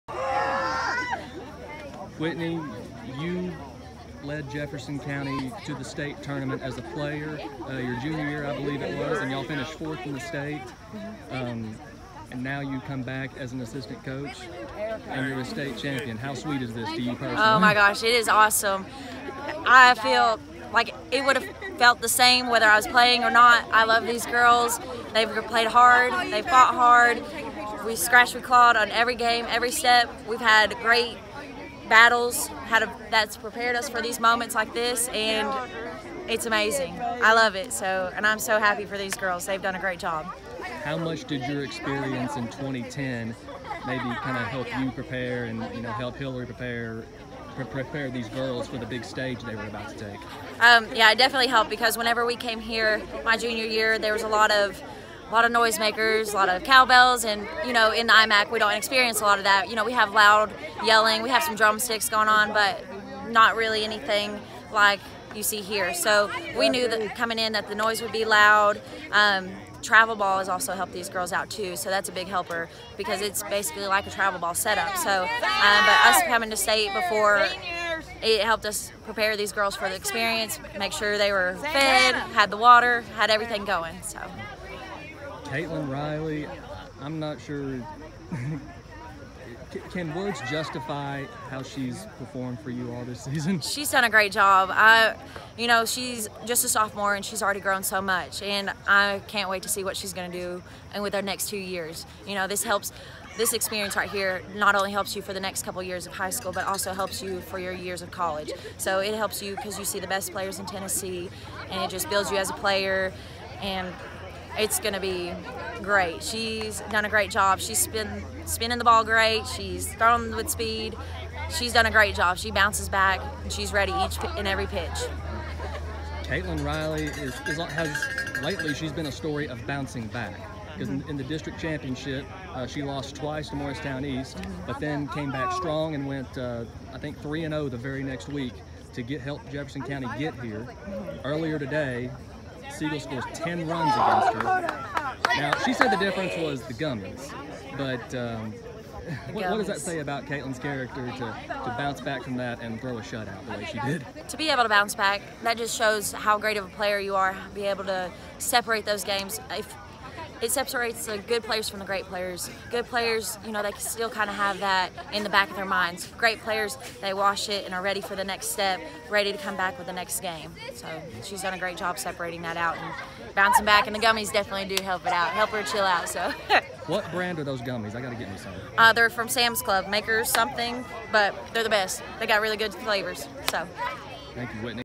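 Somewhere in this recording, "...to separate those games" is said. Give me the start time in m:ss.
2:37.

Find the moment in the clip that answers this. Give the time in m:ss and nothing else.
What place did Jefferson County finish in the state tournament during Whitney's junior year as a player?
0:09.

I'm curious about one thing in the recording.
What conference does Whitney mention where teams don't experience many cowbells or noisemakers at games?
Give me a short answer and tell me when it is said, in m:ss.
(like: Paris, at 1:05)
IMAC, at 0:58.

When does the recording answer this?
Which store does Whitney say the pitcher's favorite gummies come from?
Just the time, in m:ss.
2:59.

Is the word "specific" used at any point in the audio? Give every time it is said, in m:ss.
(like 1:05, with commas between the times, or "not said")
not said.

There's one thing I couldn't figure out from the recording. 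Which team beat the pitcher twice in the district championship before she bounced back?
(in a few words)
Morristown East.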